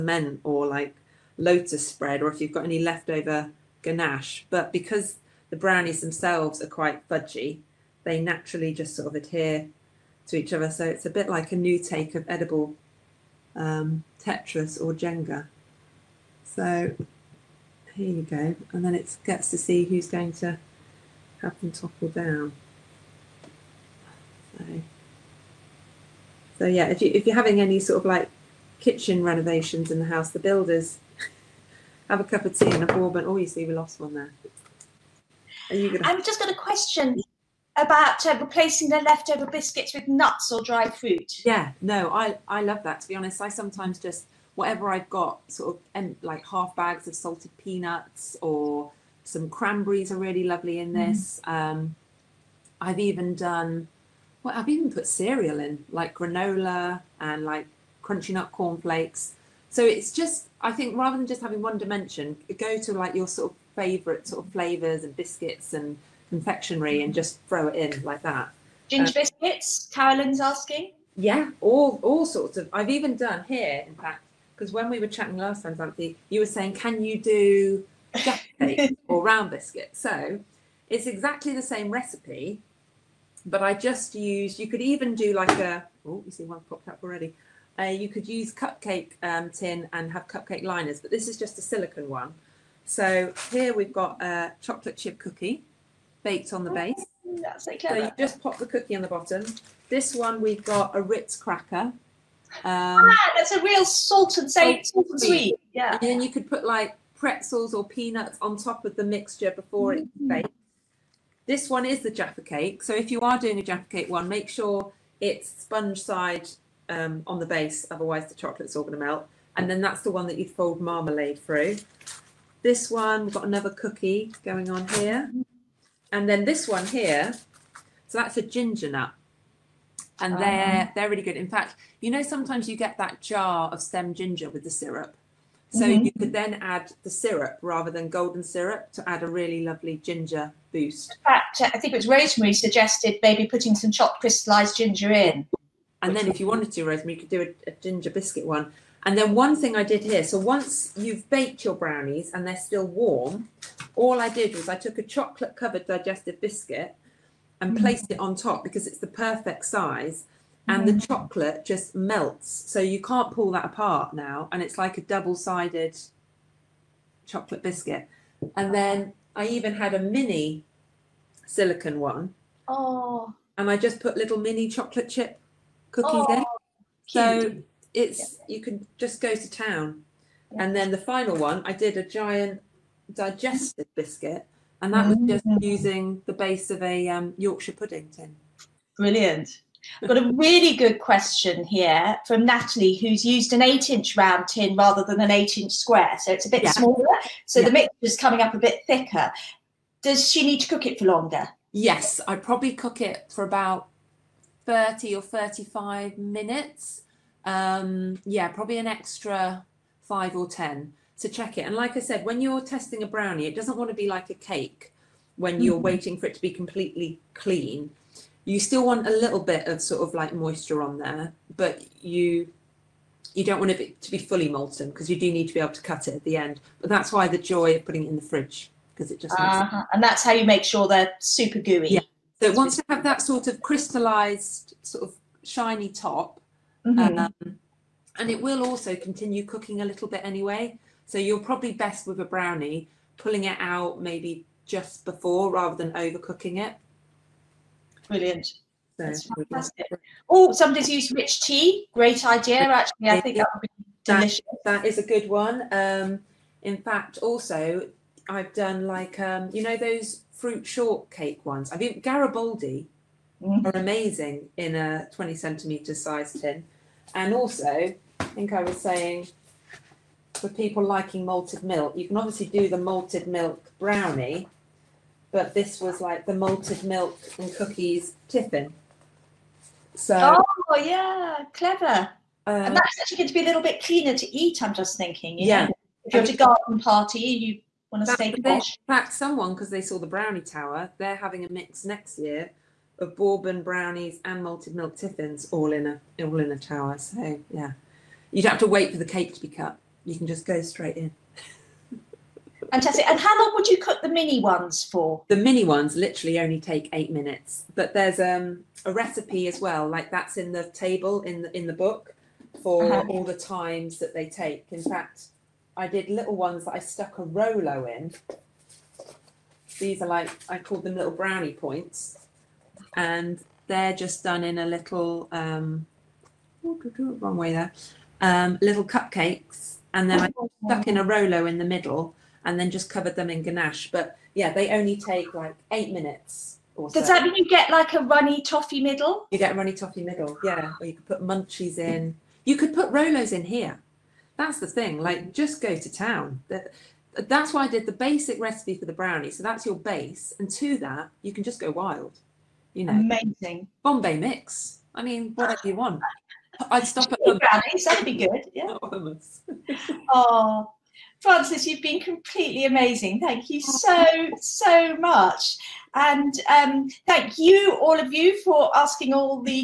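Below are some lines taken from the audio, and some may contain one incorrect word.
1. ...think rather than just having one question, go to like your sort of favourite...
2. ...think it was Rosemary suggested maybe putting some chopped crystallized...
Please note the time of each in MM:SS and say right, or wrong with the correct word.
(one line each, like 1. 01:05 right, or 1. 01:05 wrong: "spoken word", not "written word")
1. 01:00 wrong: "dimension", not "question"
2. 02:21 right.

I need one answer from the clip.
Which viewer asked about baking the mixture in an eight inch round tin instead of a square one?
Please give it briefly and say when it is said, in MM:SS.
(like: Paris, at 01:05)
Natalie, at 03:12.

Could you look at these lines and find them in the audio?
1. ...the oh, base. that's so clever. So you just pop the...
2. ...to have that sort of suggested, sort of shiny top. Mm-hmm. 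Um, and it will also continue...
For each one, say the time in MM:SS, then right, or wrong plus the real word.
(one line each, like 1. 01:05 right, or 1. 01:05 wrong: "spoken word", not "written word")
1. 01:36 right
2. 03:52 wrong: "crystallized", not "suggested".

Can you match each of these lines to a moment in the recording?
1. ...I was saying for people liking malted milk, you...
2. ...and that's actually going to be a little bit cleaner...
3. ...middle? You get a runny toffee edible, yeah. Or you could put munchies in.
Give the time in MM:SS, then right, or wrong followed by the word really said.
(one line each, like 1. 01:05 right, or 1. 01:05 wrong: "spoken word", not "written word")
1. 04:28 right
2. 04:42 right
3. 05:38 wrong: "middle", not "edible".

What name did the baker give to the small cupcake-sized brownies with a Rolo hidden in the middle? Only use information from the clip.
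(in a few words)
little brownie points.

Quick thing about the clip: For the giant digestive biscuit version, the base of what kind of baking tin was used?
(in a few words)
Yorkshire pudding tin.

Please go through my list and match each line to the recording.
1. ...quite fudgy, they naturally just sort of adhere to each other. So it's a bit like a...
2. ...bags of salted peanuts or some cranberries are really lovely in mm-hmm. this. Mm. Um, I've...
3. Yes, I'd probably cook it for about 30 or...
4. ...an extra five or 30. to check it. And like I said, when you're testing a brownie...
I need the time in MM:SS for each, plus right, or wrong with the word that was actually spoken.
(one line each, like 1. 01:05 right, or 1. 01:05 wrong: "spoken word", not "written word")
1. 00:06 right
2. 00:46 right
3. 03:21 right
4. 03:28 wrong: "10", not "30".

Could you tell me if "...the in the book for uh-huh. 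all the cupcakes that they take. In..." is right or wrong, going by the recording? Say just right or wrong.
wrong.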